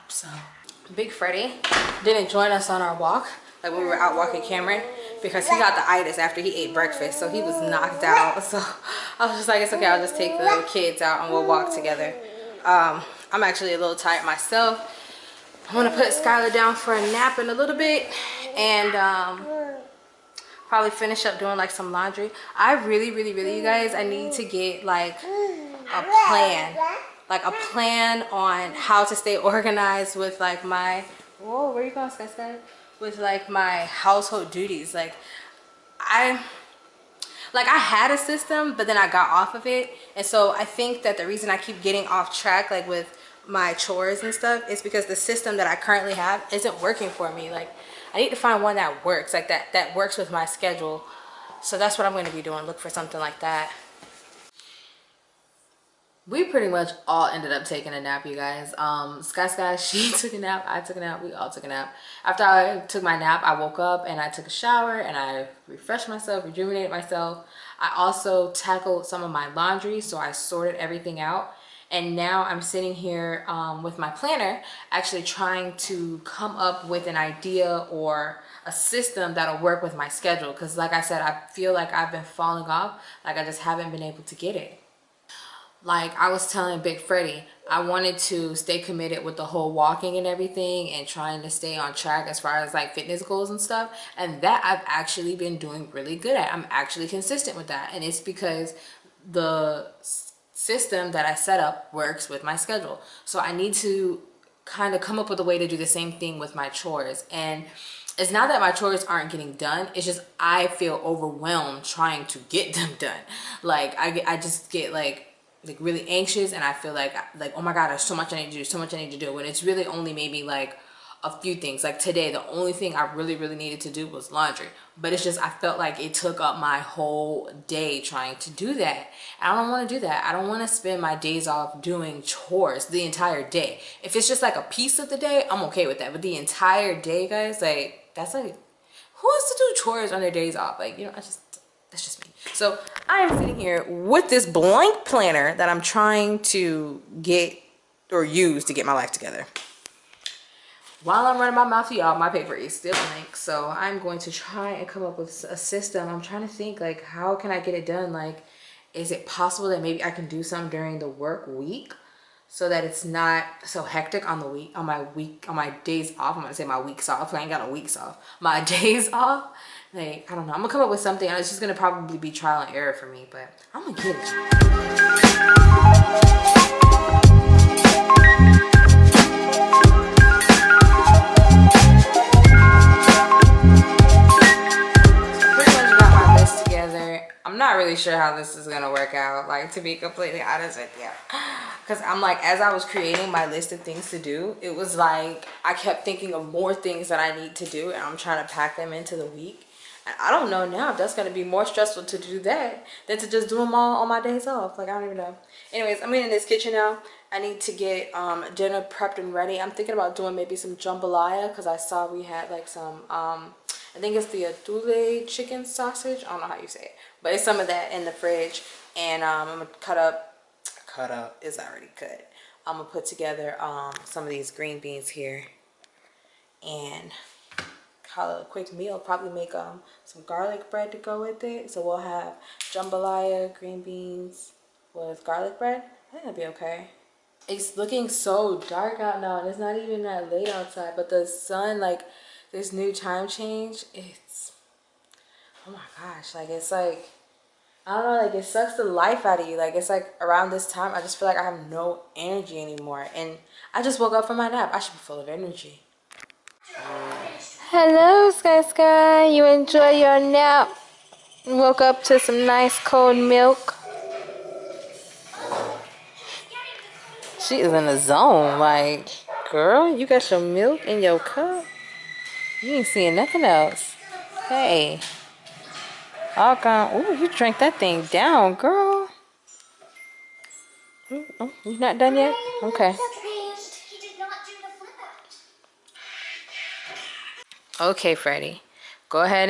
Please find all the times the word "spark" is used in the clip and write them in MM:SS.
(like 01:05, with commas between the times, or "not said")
not said.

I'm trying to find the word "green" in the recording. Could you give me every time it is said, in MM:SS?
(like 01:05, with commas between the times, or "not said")
03:44, 03:53.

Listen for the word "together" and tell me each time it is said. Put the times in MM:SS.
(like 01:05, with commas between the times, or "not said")
00:11, 02:29, 03:43.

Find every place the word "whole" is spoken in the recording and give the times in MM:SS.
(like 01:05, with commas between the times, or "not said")
01:29, 02:06.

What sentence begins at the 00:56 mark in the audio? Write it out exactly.
We pretty much all ended up taking a nap, you guys.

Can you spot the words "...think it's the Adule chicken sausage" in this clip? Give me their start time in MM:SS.
03:33.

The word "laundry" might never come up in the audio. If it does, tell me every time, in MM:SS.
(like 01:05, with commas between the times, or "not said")
00:21, 01:09, 02:04.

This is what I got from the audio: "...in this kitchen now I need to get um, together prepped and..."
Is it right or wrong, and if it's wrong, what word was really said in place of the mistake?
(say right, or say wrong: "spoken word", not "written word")
wrong: "dinner", not "together".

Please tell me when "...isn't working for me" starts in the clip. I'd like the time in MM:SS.
00:46.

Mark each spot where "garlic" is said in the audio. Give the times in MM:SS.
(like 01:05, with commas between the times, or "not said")
03:50, 03:55.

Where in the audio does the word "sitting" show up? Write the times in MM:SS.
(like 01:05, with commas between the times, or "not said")
01:12, 02:23.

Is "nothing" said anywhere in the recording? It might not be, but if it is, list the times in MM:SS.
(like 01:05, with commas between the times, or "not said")
04:33.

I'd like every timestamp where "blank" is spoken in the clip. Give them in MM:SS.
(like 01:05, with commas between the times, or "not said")
02:24, 02:32.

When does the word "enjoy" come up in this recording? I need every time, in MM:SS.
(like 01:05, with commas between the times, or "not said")
04:19.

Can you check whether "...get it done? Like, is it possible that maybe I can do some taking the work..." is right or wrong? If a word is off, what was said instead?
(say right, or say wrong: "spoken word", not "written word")
wrong: "during", not "taking".